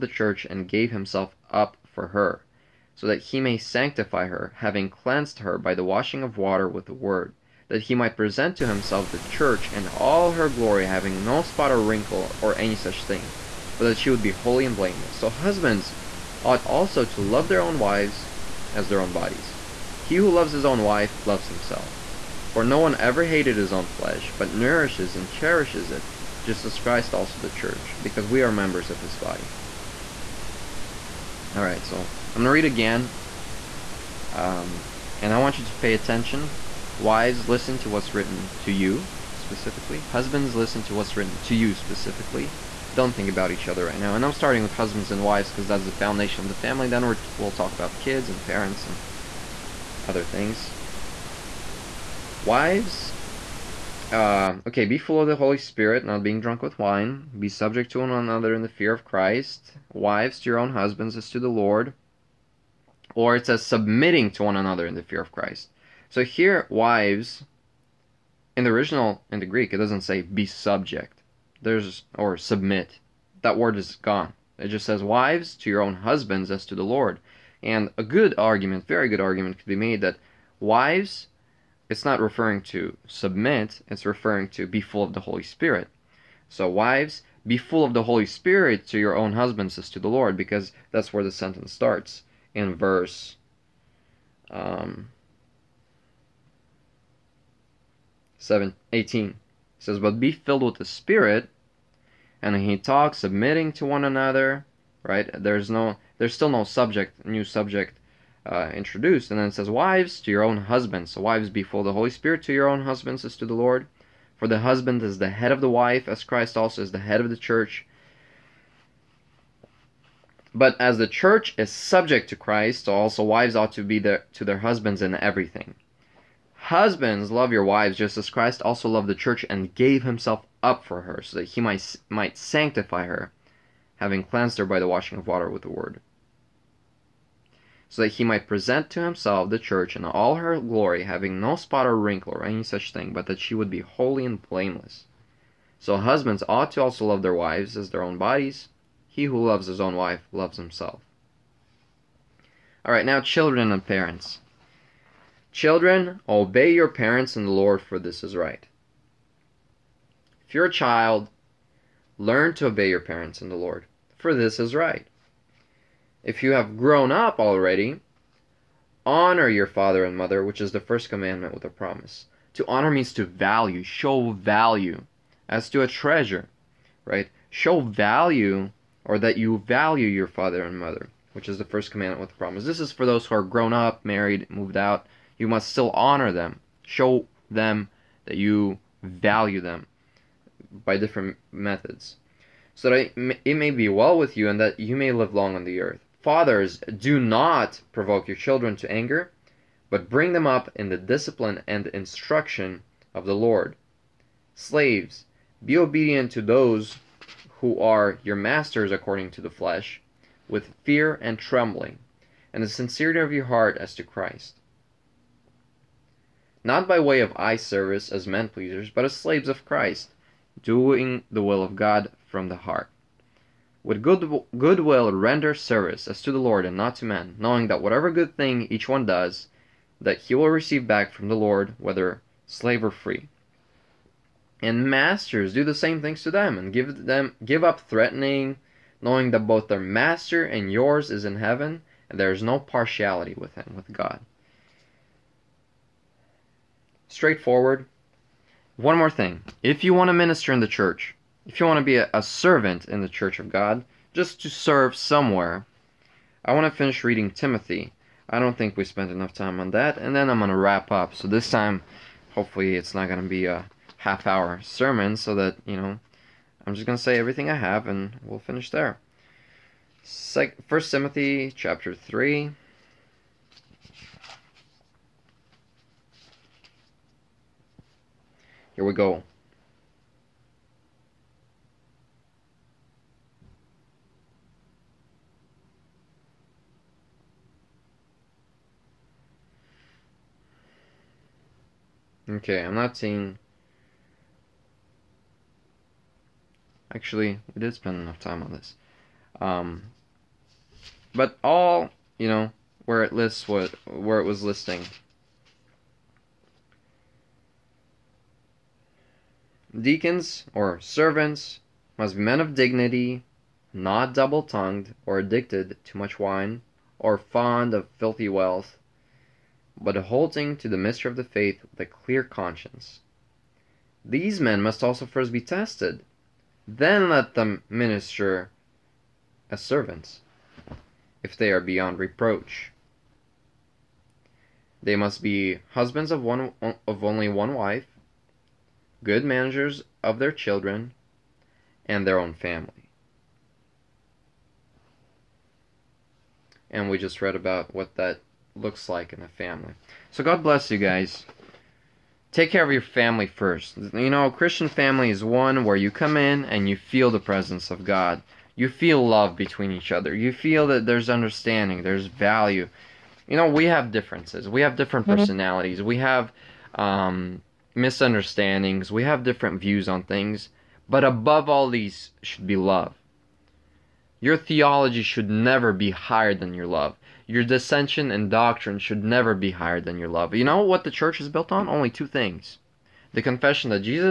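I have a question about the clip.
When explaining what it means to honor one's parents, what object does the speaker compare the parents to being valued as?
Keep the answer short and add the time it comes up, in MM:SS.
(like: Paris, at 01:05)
A treasure, at 02:55.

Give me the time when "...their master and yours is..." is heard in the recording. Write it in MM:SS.
03:59.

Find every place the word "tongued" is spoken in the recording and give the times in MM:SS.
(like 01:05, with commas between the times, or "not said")
05:14.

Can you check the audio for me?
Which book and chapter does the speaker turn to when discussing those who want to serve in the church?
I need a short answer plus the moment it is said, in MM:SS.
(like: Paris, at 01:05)
First Timothy chapter 3, at 04:30.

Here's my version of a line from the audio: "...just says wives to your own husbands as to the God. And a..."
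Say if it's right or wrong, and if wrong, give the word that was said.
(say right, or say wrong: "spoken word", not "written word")
wrong: "Lord", not "God".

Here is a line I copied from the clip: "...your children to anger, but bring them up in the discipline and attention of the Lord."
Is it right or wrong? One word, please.
wrong.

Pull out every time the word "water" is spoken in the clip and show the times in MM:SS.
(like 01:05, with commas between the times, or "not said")
00:06, 02:15.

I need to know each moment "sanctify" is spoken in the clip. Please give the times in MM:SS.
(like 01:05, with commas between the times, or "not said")
00:03, 02:12.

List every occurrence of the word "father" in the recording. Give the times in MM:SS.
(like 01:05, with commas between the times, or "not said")
02:49, 03:00, 03:16.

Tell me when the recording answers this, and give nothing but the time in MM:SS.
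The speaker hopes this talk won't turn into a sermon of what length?
04:23.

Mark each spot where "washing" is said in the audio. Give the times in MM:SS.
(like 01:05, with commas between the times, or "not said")
00:05, 02:14.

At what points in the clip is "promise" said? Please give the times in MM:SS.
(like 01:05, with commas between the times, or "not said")
02:51, 03:02.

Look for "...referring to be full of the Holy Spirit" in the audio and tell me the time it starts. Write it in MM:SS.
01:24.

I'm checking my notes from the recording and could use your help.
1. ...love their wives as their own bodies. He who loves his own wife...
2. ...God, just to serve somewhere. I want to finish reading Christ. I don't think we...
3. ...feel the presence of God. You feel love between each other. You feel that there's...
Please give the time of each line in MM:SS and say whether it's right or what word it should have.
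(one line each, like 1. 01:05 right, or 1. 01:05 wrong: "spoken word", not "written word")
1. 02:27 right
2. 04:13 wrong: "Timothy", not "Christ"
3. 05:56 right.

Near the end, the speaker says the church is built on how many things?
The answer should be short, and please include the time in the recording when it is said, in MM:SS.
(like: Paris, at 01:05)
2, at 06:21.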